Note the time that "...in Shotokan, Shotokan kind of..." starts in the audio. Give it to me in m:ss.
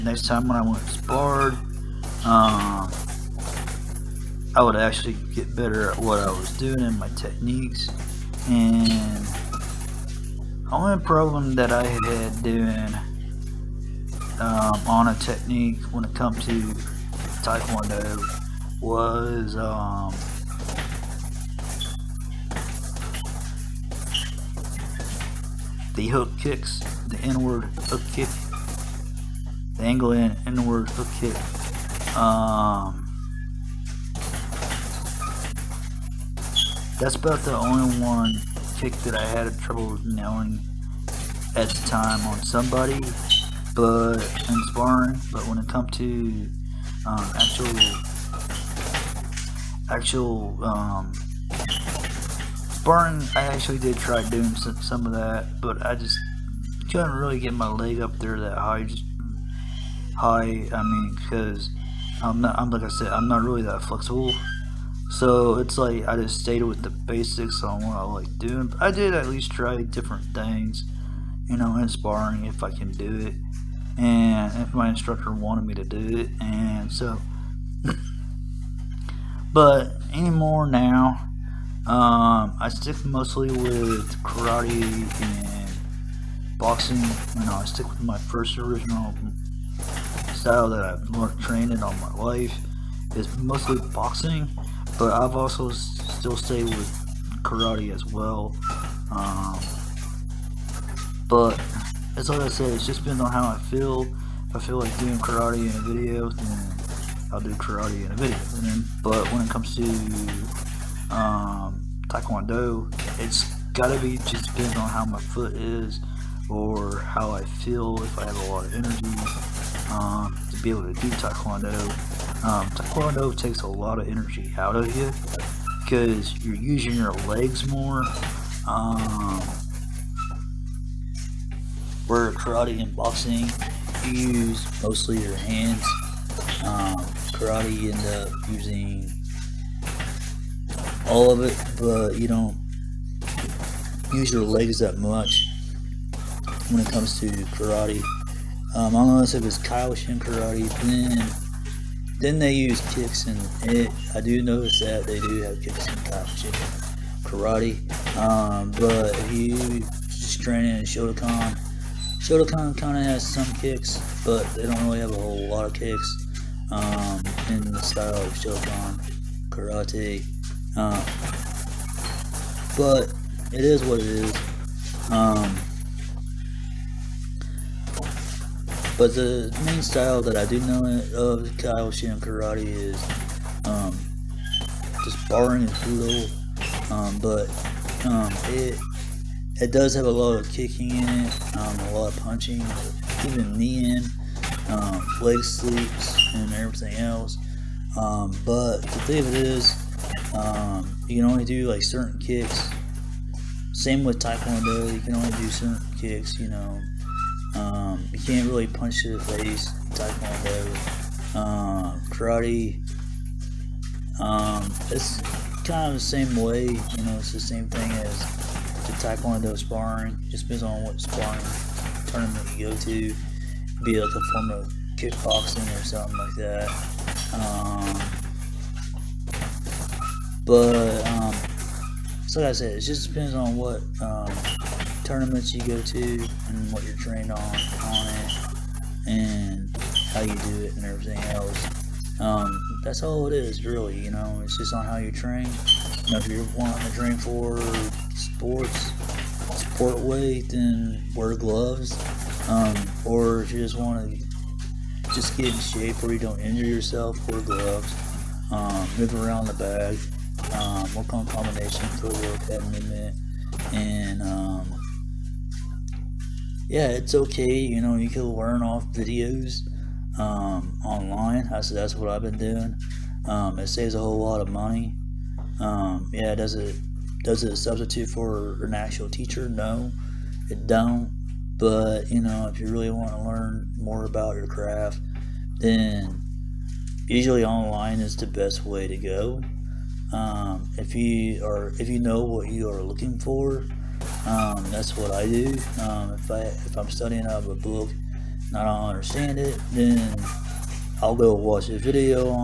2:40.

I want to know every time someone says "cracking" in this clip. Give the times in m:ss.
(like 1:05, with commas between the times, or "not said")
not said.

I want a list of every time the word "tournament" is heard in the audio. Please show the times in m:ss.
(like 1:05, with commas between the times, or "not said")
3:42, 3:55.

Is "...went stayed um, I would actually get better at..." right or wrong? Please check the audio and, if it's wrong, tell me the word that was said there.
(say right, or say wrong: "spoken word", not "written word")
wrong: "explored", not "stayed".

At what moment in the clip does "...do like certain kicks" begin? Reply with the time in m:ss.
3:21.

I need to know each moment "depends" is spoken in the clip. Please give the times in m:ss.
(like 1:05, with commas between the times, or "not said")
1:43, 1:54, 3:40, 3:53.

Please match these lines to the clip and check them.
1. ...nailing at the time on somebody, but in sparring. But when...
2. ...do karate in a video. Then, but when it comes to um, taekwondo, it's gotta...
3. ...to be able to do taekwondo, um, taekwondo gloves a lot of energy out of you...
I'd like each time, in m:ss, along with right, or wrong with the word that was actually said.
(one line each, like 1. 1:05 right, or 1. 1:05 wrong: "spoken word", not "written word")
1. 0:40 right
2. 1:47 right
3. 2:00 wrong: "takes", not "gloves".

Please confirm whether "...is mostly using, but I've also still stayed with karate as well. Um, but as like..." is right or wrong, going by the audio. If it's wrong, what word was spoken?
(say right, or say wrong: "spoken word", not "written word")
wrong: "boxing", not "using".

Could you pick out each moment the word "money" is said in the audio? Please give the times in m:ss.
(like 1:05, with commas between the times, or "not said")
4:34.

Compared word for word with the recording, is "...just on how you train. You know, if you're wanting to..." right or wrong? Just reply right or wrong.
right.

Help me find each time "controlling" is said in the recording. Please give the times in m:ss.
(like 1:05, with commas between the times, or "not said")
not said.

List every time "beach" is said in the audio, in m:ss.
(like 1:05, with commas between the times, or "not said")
not said.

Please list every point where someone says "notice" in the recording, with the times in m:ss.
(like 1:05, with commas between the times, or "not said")
2:34.